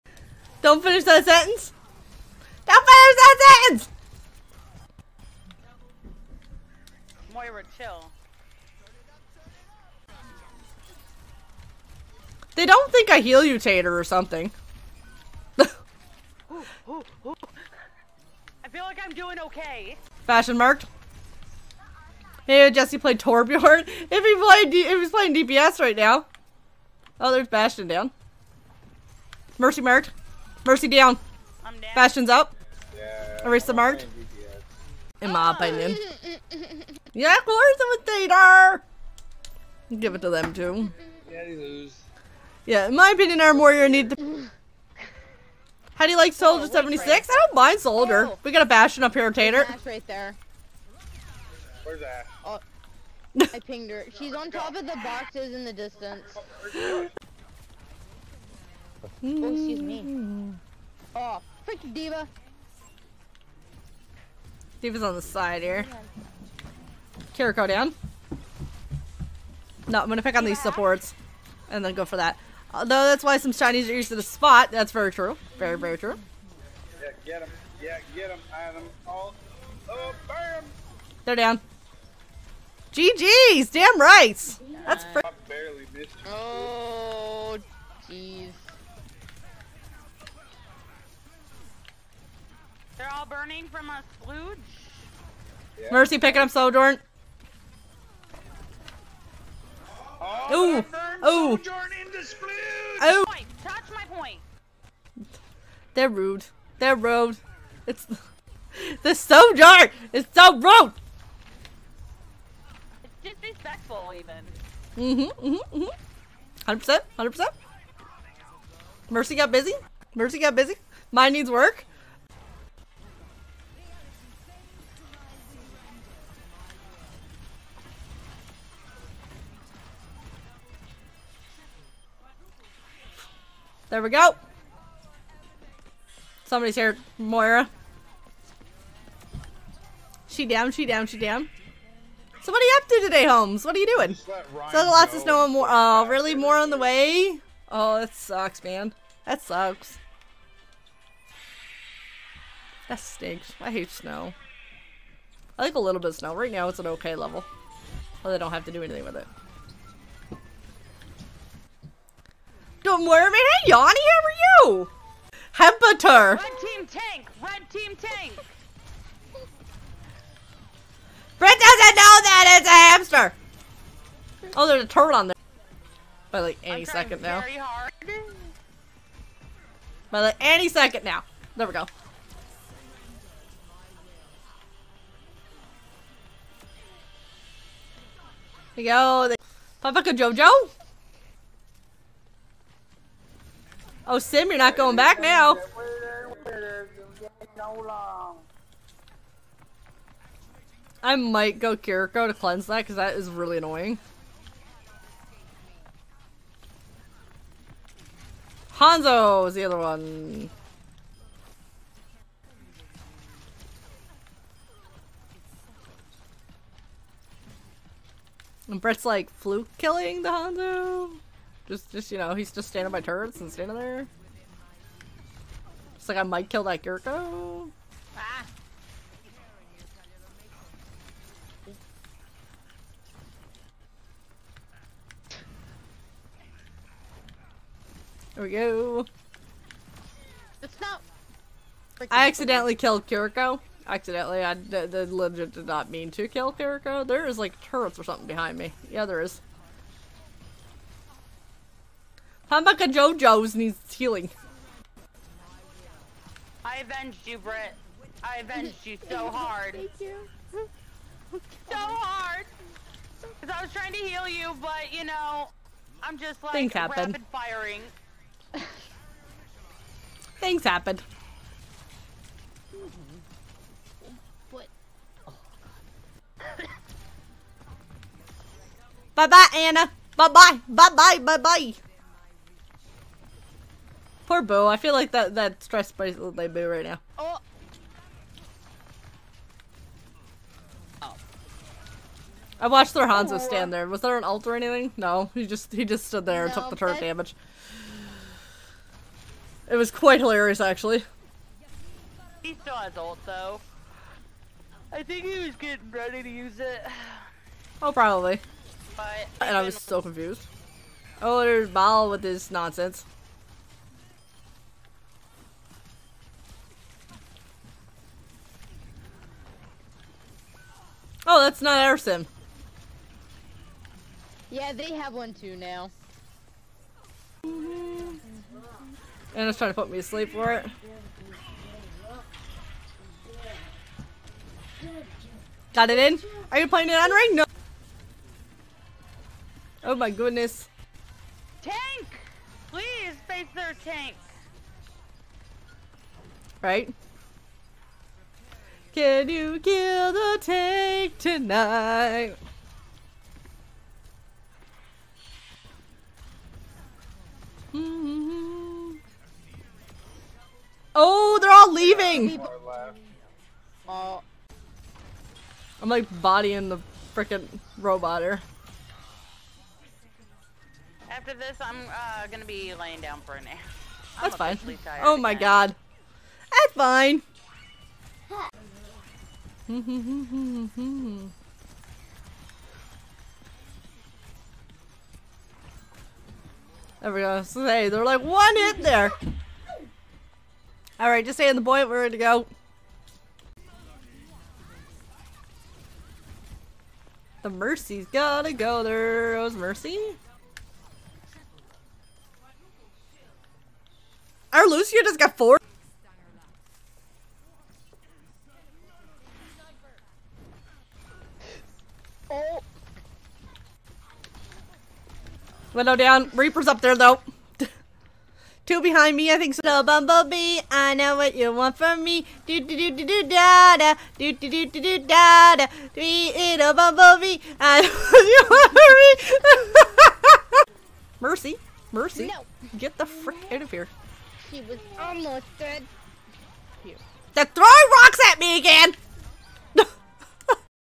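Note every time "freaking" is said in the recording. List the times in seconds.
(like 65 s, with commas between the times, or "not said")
61 s, 367 s.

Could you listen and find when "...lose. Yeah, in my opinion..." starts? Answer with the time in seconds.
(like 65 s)
41 s.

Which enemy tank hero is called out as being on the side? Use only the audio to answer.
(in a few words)
D.Va.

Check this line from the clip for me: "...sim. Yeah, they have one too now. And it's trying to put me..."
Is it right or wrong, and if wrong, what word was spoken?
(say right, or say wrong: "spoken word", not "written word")
right.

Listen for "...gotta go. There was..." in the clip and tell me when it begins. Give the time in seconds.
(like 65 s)
398 s.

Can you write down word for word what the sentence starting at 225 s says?
Just like I might kill that Gurko.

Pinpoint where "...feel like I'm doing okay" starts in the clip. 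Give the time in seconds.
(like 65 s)
18 s.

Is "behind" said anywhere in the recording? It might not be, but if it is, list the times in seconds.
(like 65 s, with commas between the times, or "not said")
248 s, 418 s.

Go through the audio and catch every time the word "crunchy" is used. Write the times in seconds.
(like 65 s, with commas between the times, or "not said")
not said.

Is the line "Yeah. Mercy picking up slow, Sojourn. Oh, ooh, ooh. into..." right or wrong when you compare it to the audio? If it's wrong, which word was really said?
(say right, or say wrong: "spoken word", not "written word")
right.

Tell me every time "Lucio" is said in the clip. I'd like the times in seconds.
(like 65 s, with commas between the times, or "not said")
404 s.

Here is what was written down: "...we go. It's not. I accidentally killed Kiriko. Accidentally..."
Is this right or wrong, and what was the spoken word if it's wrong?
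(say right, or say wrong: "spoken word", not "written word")
right.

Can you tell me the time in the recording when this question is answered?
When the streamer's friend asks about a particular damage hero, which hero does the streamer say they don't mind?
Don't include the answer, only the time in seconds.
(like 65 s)
46 s.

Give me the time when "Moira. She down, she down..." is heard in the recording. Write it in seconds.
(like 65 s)
137 s.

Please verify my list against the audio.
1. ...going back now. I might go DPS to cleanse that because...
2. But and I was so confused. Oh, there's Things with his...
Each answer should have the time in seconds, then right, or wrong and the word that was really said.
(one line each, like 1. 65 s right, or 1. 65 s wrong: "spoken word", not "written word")
1. 194 s wrong: "Kiriko", not "DPS"
2. 308 s wrong: "Bal", not "Things".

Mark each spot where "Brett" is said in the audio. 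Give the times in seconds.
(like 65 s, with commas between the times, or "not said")
218 s.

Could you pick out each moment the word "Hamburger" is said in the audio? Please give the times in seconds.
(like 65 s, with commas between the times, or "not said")
252 s.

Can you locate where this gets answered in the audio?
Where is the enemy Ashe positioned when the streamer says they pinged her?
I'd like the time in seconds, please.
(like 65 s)
54 s.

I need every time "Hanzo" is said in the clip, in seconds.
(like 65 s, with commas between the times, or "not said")
208 s, 220 s, 293 s.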